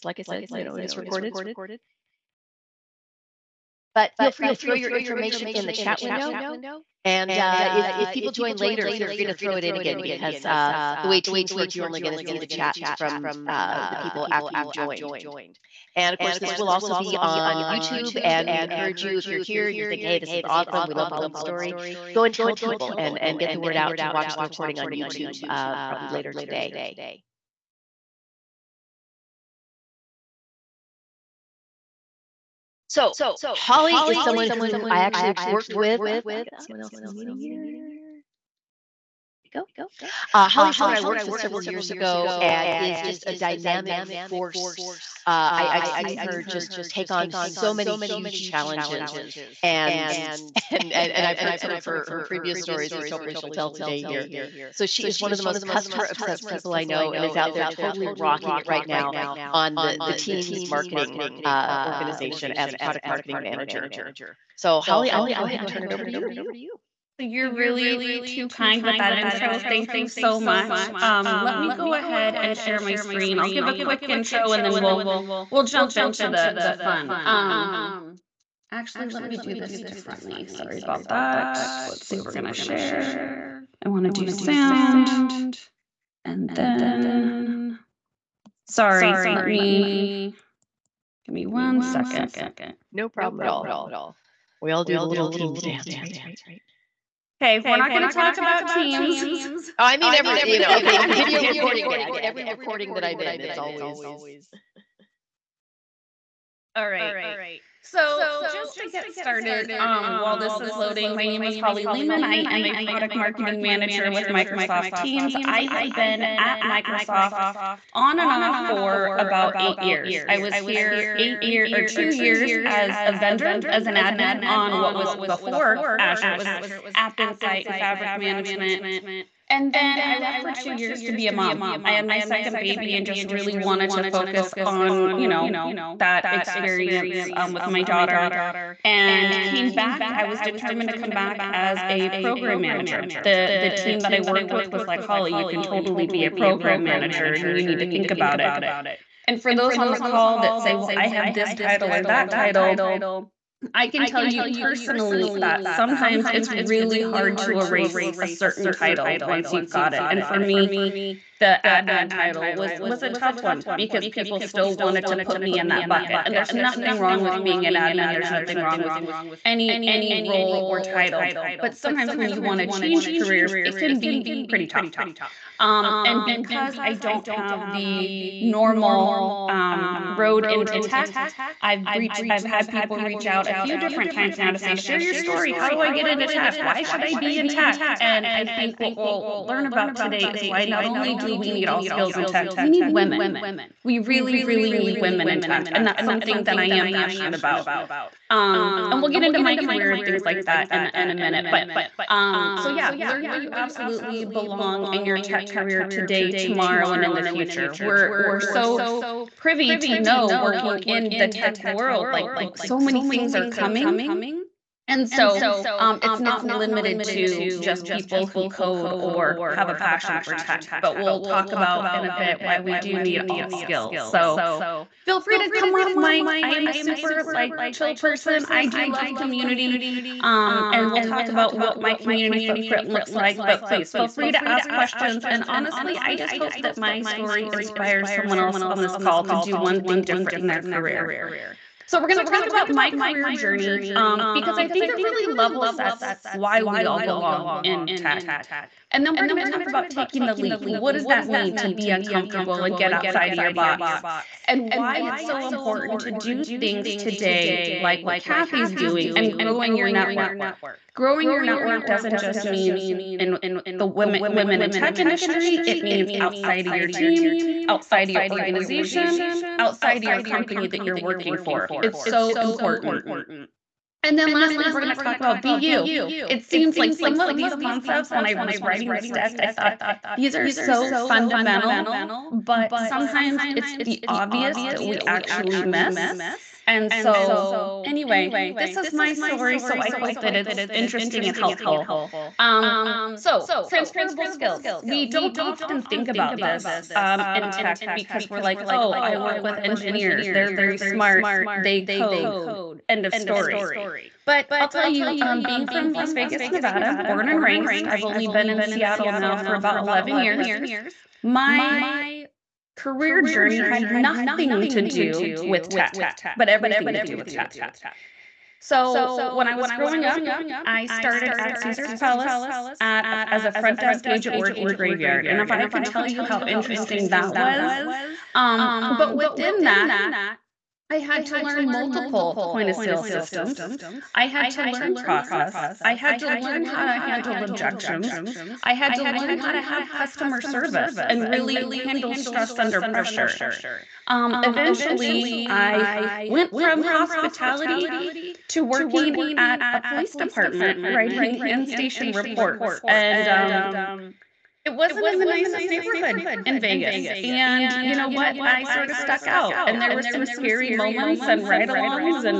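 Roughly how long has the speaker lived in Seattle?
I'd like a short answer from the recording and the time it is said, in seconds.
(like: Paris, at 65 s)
11 years, at 309 s.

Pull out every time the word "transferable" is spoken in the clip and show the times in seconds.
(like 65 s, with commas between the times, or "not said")
293 s.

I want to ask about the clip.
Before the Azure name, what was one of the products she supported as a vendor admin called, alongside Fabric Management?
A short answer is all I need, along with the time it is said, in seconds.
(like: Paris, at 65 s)
App Insight, at 126 s.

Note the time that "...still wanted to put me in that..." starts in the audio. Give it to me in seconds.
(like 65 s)
164 s.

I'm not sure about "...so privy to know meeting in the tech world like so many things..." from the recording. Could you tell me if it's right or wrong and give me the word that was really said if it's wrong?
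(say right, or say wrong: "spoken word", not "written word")
wrong: "working", not "meeting".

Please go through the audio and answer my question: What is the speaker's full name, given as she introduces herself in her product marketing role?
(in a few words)
Holly Lehman.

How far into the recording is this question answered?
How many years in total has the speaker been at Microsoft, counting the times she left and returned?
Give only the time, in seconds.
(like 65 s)
119 s.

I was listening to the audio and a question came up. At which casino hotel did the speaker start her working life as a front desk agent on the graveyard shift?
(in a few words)
Caesar's Palace.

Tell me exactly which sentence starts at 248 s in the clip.
And then we're going to talk about taking the leap.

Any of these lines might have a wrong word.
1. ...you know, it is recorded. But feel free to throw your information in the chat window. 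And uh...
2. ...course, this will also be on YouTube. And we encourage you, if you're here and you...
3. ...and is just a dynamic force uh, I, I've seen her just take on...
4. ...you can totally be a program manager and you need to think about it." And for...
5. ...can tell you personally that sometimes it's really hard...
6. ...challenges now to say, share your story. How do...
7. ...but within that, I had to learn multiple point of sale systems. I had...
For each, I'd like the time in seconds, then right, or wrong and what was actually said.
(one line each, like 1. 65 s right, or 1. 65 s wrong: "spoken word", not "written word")
1. 0 s right
2. 16 s right
3. 42 s right
4. 145 s right
5. 153 s right
6. 184 s wrong: "times", not "challenges"
7. 328 s right.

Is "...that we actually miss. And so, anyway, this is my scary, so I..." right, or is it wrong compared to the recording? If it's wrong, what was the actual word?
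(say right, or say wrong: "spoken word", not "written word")
wrong: "story", not "scary".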